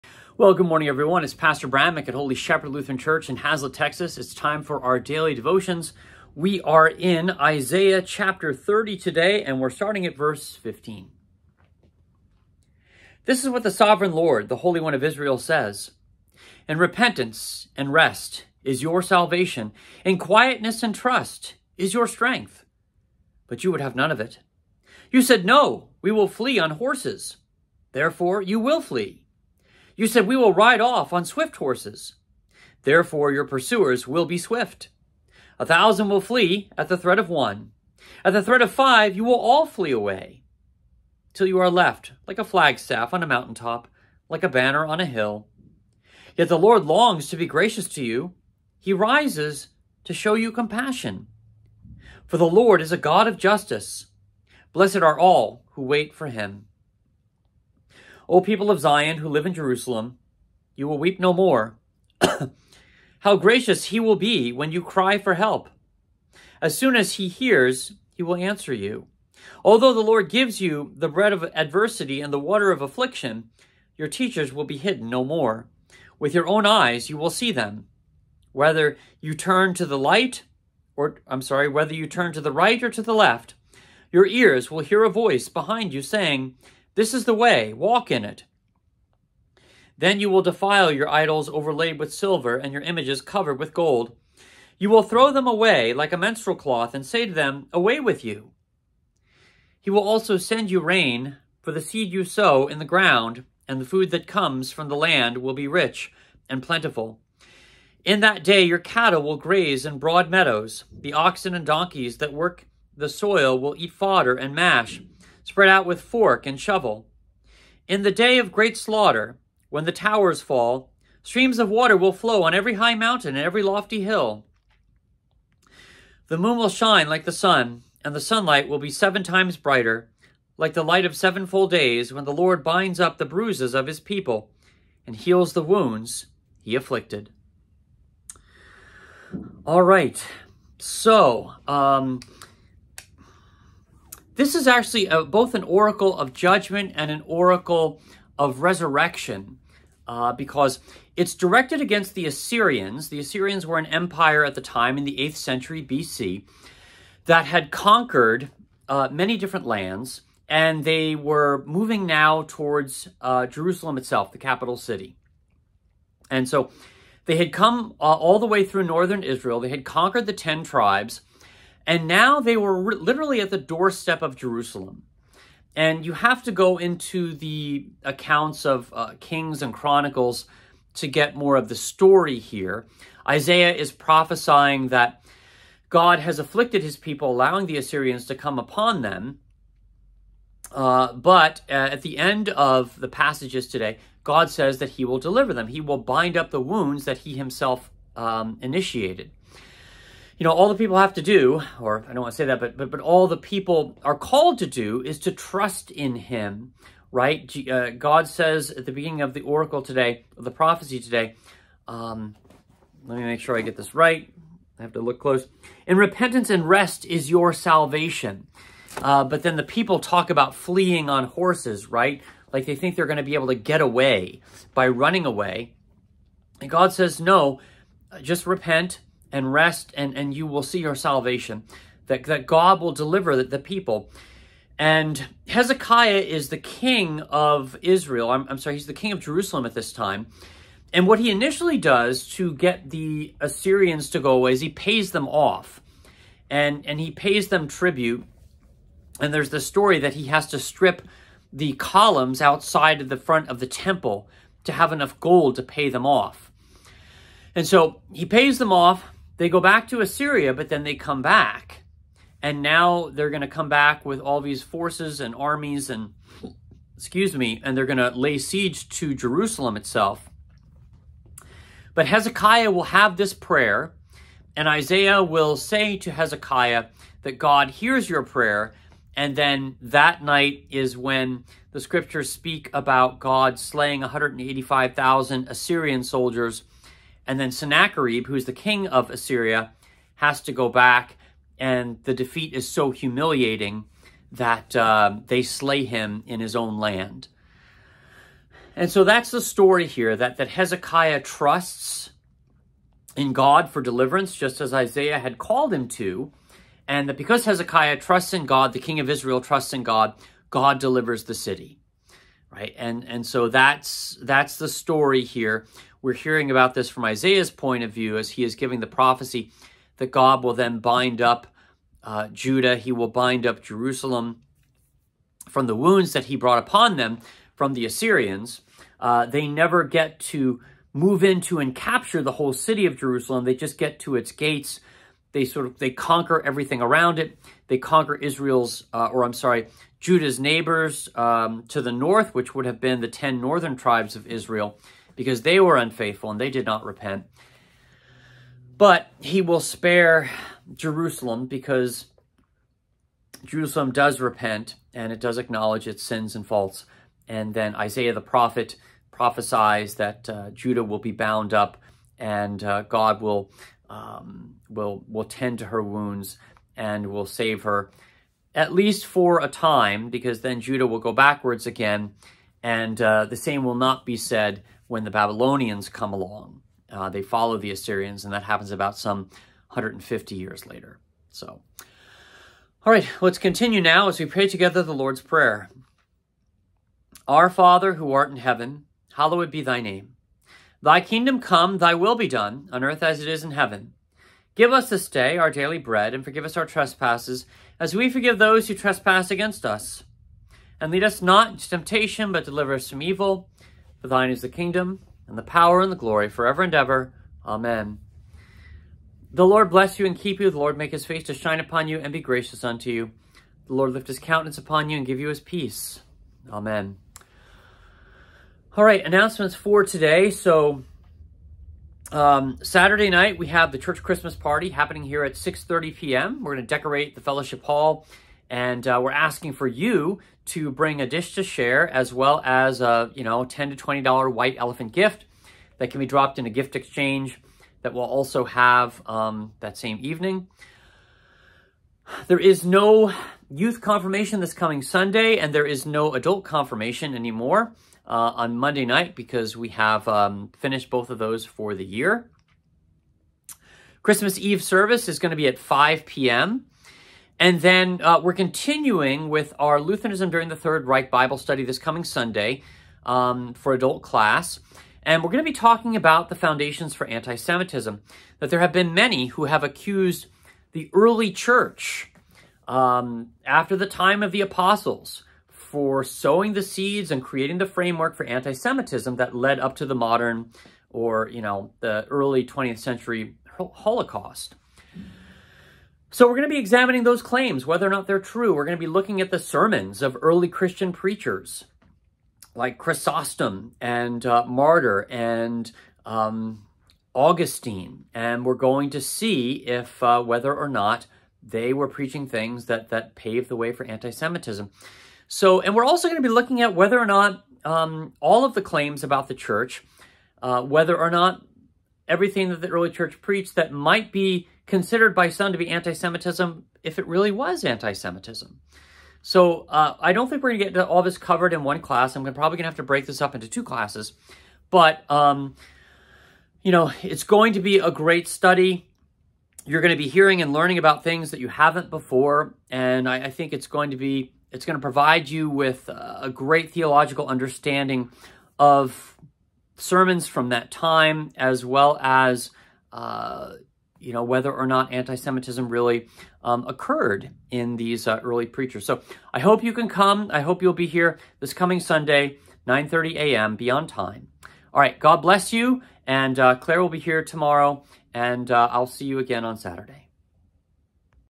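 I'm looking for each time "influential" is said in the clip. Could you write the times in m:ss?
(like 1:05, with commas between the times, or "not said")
not said.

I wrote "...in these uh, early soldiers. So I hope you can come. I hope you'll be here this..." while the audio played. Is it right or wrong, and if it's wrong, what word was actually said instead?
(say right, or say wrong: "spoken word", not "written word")
wrong: "preachers", not "soldiers".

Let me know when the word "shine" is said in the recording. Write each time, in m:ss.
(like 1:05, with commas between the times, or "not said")
2:06, 6:51.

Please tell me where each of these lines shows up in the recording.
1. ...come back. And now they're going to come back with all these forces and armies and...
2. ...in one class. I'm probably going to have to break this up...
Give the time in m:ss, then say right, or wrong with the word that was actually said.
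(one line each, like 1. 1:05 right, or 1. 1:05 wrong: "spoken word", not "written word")
1. 4:20 right
2. 8:41 right.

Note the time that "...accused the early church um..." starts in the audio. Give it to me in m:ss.
7:49.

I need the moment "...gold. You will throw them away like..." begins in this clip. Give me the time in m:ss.
1:33.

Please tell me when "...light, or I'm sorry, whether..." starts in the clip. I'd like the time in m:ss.
1:19.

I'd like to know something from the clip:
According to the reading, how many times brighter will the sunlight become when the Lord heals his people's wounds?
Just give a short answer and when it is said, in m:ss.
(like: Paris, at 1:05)
7, at 2:08.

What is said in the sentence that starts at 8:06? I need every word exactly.
So we're going to be examining those claims, whether or not they're true.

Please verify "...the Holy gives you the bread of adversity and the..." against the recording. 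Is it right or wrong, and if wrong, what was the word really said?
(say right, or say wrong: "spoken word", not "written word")
wrong: "Lord", not "Holy".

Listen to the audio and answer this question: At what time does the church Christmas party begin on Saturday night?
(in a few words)
6:30 p.m.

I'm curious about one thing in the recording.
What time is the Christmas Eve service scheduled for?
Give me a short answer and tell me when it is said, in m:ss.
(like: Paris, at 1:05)
5 p.m., at 7:35.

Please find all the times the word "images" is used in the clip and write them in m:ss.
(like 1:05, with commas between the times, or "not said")
1:32.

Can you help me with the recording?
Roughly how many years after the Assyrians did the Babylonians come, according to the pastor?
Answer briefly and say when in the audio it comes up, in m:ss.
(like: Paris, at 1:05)
150 years, at 6:19.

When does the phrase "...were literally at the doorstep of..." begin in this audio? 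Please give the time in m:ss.
2:52.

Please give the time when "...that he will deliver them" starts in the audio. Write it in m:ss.
3:14.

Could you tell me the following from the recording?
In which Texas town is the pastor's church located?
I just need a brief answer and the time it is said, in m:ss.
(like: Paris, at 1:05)
Haslet, at 0:03.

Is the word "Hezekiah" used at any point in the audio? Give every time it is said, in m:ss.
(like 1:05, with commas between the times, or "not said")
3:55, 4:32, 4:36, 5:00, 5:07.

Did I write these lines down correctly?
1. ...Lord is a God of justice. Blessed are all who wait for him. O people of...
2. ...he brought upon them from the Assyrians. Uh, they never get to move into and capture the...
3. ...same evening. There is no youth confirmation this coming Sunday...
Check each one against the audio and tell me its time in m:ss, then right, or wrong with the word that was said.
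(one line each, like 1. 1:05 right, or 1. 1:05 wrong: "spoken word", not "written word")
1. 0:52 right
2. 5:26 right
3. 7:19 right.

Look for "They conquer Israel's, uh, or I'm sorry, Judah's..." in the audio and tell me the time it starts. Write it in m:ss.
5:37.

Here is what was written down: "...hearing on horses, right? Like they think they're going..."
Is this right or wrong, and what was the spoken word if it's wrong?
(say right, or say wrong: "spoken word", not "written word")
wrong: "fleeing", not "hearing".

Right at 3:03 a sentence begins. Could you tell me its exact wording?
Isaiah is prophesying that God has afflicted his people, allowing the Assyrians to come upon them.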